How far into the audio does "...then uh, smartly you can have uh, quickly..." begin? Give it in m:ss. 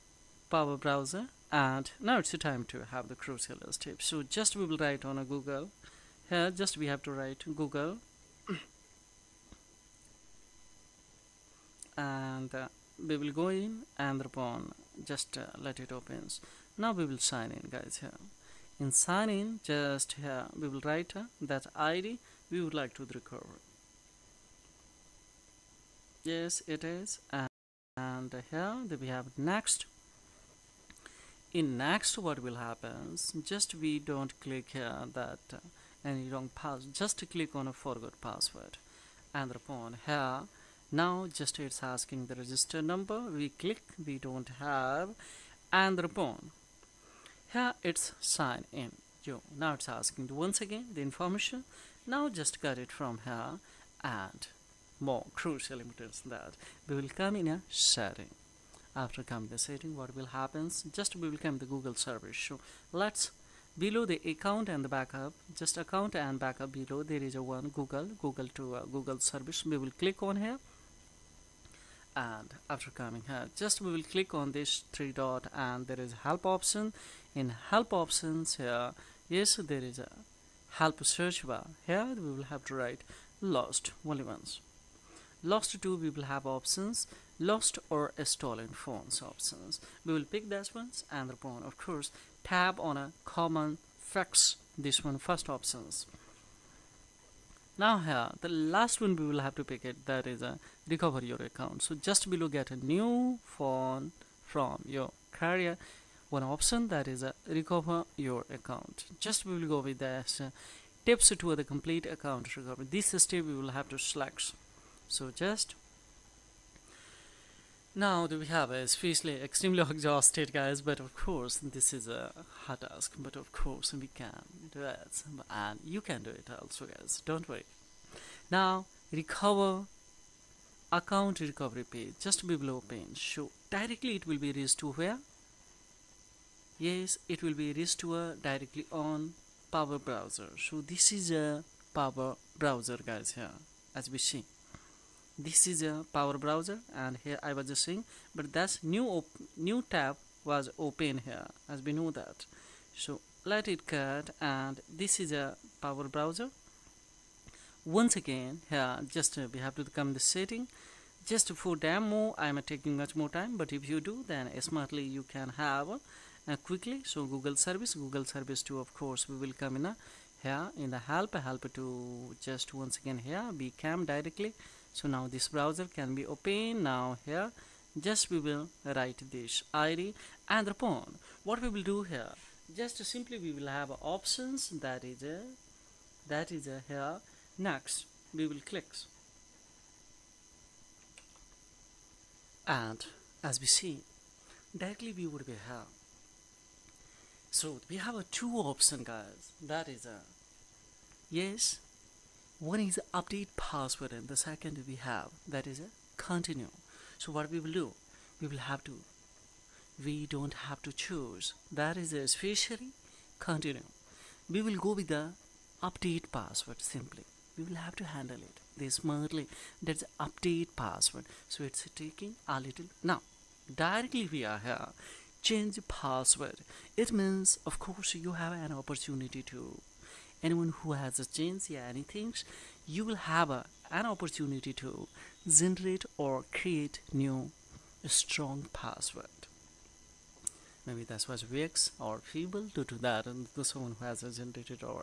2:44.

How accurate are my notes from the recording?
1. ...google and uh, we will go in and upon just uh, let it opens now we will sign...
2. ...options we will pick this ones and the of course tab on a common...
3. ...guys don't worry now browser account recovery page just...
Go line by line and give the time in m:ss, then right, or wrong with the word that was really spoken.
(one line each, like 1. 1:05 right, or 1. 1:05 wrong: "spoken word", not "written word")
1. 0:07 right
2. 1:29 right
3. 2:06 wrong: "recover", not "browser".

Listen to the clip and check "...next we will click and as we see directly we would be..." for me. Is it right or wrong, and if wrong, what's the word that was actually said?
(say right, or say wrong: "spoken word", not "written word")
right.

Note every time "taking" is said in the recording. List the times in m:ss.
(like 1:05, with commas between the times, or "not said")
2:42, 3:41.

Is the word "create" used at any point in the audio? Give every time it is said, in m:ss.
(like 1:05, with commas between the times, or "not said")
3:56.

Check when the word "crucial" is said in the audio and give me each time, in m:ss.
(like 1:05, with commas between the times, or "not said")
0:03, 0:55.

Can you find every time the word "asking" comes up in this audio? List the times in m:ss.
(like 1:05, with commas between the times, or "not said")
0:41, 0:49.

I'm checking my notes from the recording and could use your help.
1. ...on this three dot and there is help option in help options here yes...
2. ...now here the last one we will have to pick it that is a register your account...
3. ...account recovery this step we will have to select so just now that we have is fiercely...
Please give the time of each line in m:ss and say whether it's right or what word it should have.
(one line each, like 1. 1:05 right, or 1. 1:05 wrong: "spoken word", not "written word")
1. 1:14 right
2. 1:37 wrong: "recover", not "register"
3. 1:52 right.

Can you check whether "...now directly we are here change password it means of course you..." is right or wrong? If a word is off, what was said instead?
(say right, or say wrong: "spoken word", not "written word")
right.